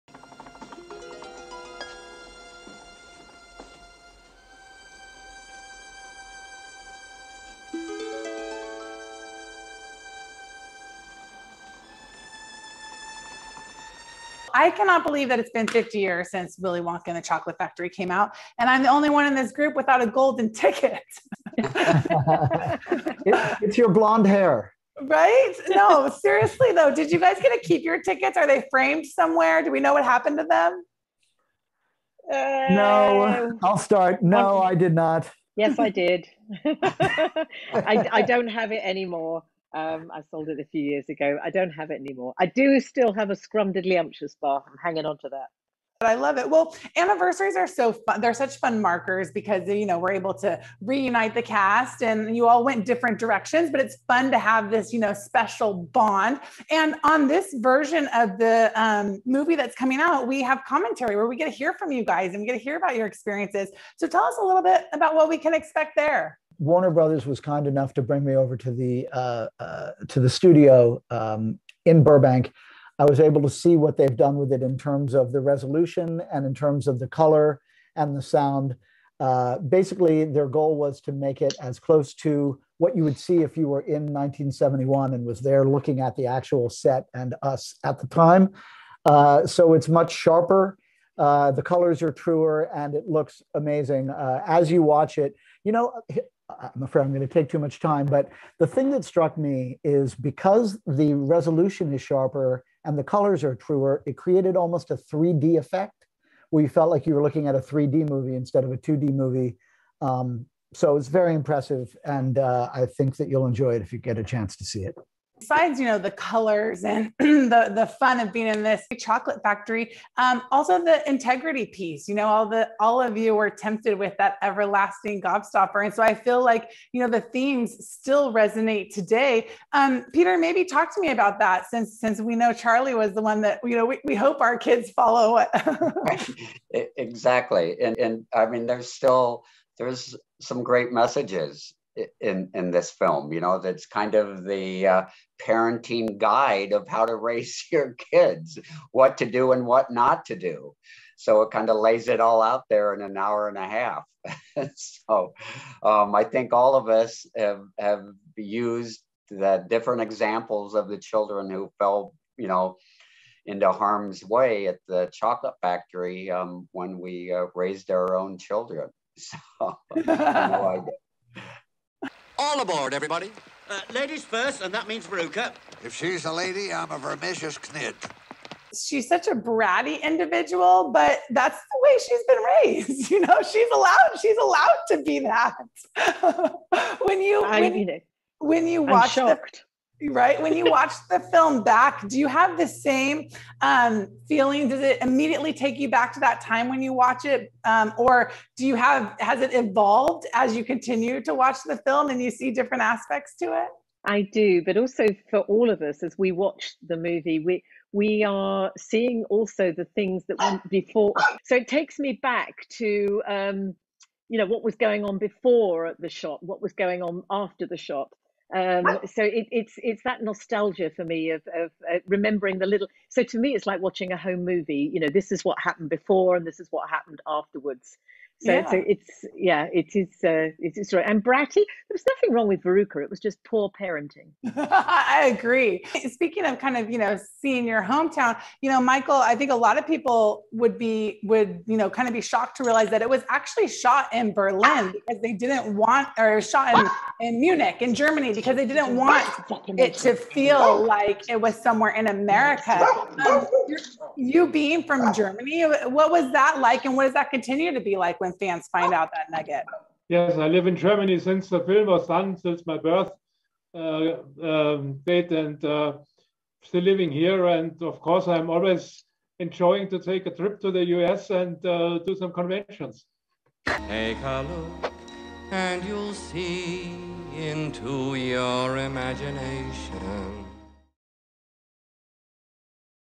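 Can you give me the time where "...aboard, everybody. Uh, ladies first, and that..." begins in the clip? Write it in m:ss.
2:52.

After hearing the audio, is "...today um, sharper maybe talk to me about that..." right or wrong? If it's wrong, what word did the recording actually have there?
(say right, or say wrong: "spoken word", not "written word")
wrong: "peter", not "sharper".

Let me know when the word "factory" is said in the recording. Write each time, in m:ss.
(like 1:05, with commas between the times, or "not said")
0:17, 1:59, 2:45.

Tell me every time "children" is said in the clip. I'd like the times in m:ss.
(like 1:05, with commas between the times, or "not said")
2:40, 2:48.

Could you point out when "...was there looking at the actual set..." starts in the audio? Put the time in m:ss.
1:25.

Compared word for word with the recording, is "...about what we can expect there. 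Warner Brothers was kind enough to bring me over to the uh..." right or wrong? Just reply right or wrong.
right.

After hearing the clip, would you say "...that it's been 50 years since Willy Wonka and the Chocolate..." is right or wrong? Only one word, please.
right.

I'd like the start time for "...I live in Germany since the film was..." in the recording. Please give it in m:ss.
4:20.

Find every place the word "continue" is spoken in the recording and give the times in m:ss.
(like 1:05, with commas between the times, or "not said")
3:20, 4:17.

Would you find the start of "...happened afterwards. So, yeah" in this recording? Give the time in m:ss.
3:46.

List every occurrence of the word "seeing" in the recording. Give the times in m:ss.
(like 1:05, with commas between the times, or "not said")
3:28, 3:57.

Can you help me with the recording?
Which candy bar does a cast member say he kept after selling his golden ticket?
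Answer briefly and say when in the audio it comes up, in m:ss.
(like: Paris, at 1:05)
Scrumdiddlyumptious bar, at 0:43.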